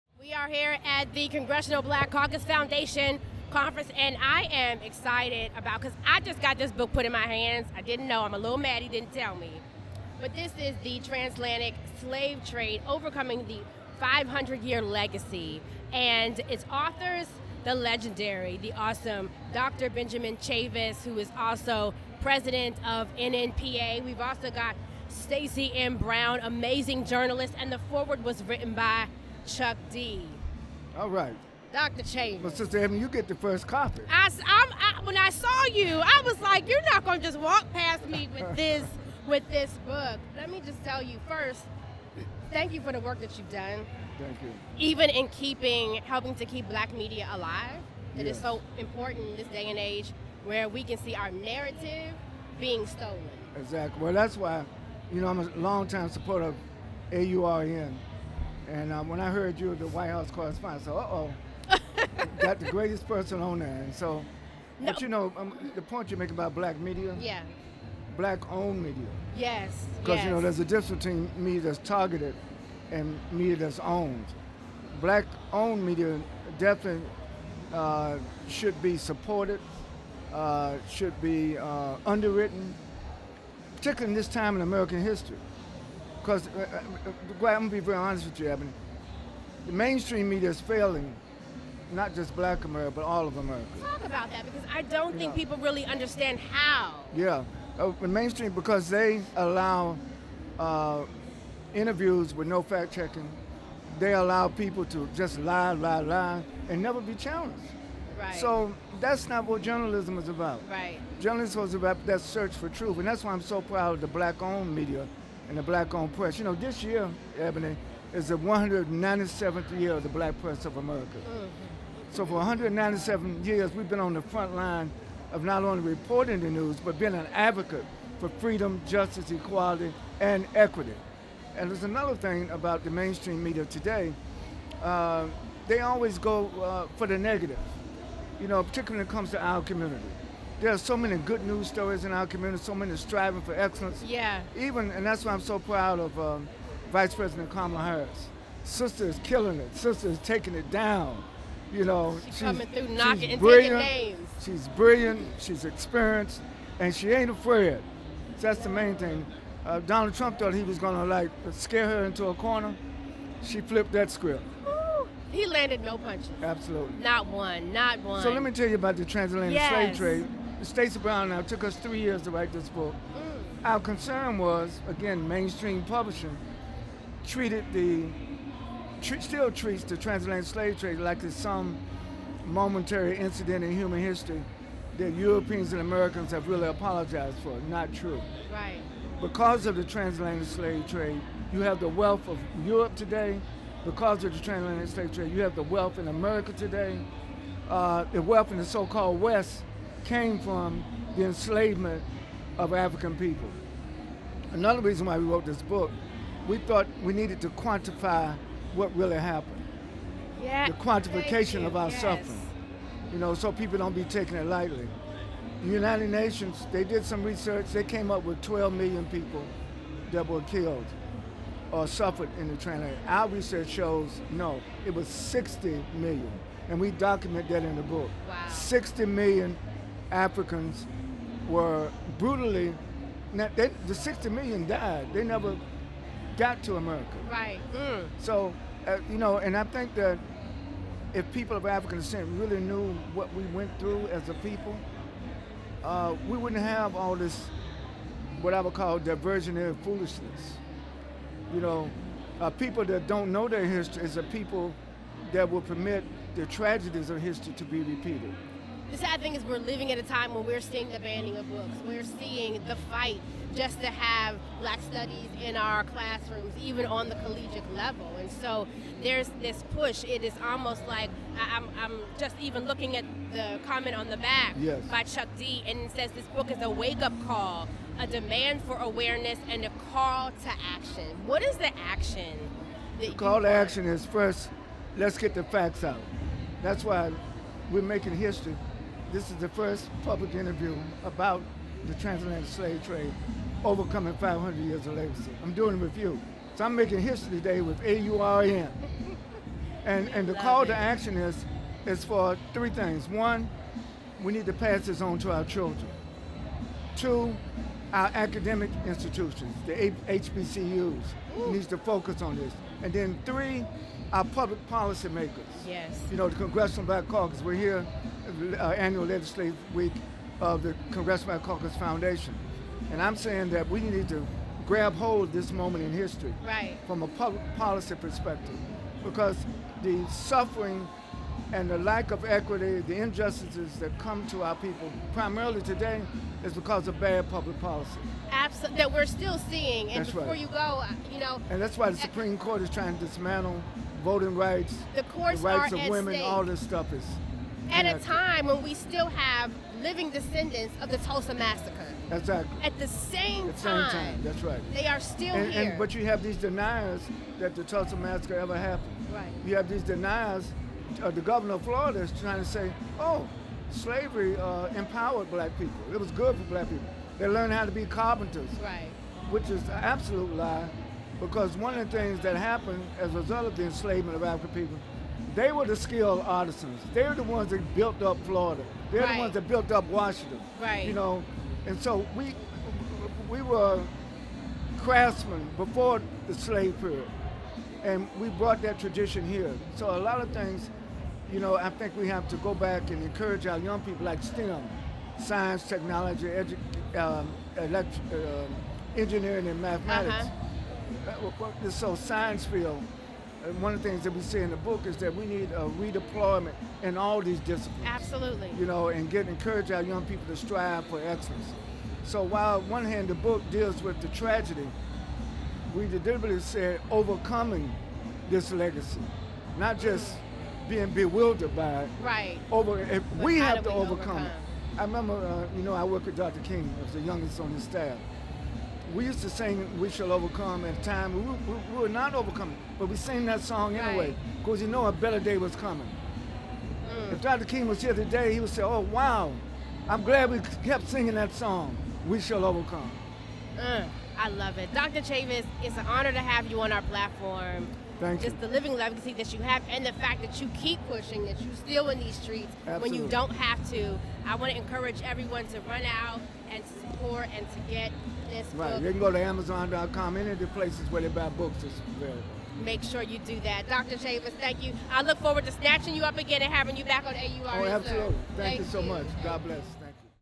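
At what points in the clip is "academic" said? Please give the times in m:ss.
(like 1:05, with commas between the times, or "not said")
5:08.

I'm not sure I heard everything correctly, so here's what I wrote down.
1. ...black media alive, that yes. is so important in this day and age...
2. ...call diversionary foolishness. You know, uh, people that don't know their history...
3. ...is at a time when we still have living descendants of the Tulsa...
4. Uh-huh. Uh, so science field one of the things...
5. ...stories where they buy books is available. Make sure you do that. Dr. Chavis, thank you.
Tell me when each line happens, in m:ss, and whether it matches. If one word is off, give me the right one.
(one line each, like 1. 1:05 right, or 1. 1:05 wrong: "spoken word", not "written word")
1. 0:46 right
2. 4:08 right
3. 5:46 right
4. 6:41 right
5. 7:40 wrong: "places", not "stories".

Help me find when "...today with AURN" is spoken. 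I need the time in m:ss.
4:57.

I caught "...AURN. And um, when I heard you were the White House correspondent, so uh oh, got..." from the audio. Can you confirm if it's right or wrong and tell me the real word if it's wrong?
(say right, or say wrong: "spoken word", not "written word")
right.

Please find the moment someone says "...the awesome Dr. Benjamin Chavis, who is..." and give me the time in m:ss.
0:18.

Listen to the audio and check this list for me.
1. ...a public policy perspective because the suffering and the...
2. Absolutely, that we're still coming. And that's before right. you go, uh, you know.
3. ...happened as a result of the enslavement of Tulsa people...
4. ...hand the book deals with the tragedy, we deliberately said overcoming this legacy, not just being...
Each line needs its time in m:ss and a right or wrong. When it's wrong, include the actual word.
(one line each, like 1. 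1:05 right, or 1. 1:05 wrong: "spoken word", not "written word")
1. 5:27 right
2. 5:38 wrong: "seeing", not "coming"
3. 6:12 wrong: "African", not "Tulsa"
4. 6:52 right.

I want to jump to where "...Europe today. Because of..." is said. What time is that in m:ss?
3:12.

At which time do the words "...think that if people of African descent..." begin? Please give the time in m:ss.
3:59.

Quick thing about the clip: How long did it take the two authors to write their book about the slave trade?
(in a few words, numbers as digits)
three years.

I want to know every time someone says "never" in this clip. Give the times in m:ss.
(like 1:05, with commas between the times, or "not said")
1:46, 3:55.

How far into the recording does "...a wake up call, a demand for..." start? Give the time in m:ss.
4:36.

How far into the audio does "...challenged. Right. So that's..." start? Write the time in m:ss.
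1:47.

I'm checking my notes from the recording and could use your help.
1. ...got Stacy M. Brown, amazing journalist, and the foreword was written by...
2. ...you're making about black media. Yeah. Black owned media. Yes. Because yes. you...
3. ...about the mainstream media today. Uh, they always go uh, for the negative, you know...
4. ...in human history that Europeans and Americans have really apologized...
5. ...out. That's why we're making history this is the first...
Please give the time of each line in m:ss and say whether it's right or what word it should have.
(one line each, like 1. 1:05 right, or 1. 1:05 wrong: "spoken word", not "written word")
1. 0:24 right
2. 1:06 right
3. 2:12 right
4. 3:03 right
5. 4:45 right.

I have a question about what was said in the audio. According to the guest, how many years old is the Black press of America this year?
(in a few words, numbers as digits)
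197.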